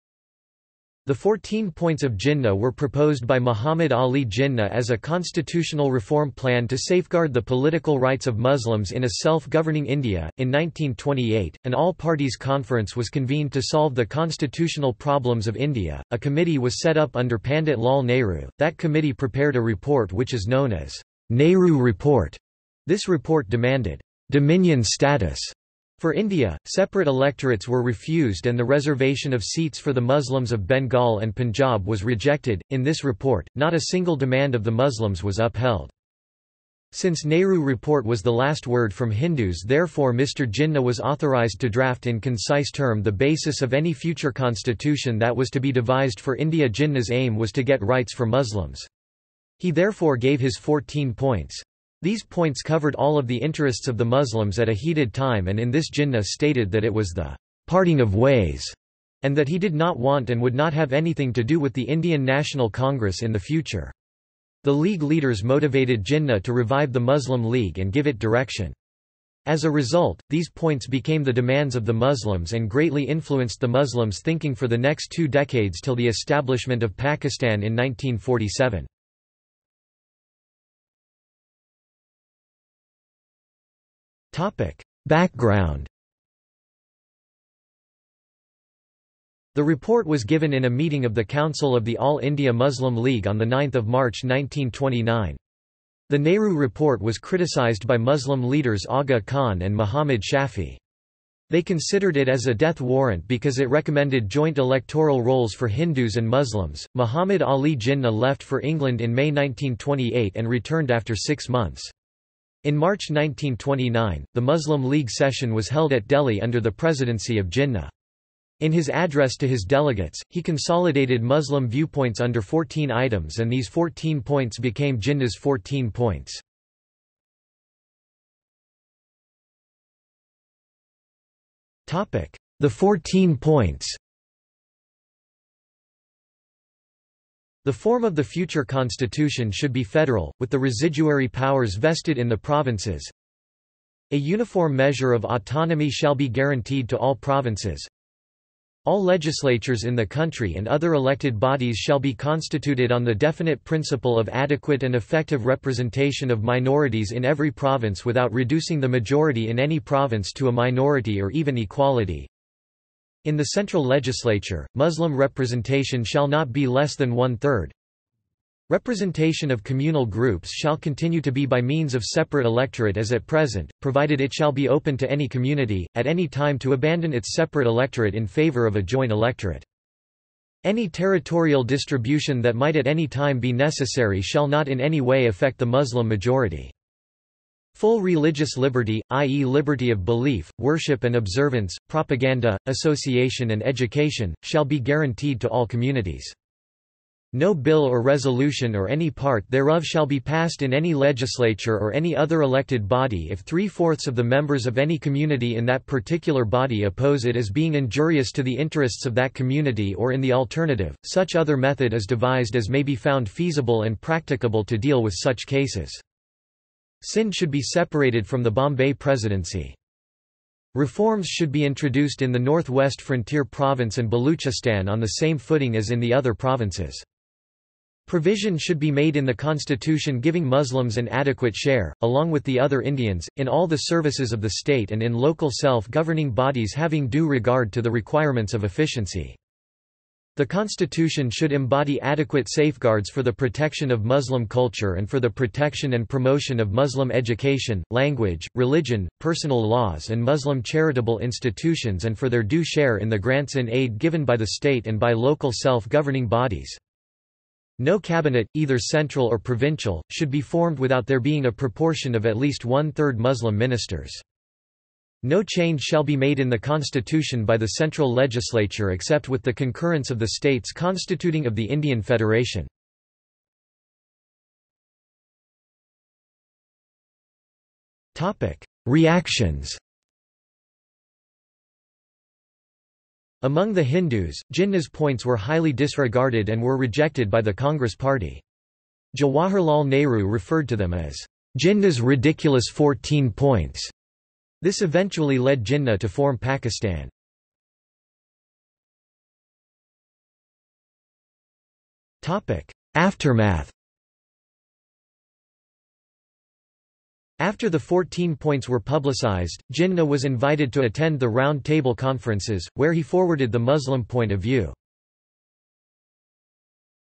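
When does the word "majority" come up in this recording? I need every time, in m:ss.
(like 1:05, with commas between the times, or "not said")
2:38, 3:06.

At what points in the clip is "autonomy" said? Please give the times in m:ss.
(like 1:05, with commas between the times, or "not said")
2:25.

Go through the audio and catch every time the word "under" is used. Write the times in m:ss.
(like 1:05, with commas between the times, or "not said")
0:17, 1:56, 2:02.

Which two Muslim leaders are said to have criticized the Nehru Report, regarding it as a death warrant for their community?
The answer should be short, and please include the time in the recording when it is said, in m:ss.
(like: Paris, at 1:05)
Aga Khan and Muhammad Shafi, at 1:38.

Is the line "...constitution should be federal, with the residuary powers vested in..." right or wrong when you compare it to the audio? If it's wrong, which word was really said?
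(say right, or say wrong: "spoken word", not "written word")
right.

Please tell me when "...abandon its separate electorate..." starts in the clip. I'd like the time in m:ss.
2:56.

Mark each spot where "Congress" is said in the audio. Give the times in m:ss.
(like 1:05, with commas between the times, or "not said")
1:02, 4:47.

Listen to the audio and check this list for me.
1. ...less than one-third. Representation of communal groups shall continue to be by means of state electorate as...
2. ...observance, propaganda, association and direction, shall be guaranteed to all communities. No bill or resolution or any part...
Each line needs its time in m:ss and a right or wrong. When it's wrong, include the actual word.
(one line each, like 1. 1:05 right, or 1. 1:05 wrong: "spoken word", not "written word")
1. 2:46 wrong: "separate", not "state"
2. 3:11 wrong: "education", not "direction".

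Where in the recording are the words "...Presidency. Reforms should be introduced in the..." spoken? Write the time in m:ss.
3:38.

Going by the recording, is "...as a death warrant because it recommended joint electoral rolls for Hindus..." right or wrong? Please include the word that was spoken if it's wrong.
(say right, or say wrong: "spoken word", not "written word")
right.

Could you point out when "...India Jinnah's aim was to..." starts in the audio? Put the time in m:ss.
0:46.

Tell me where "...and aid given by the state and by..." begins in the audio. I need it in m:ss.
4:13.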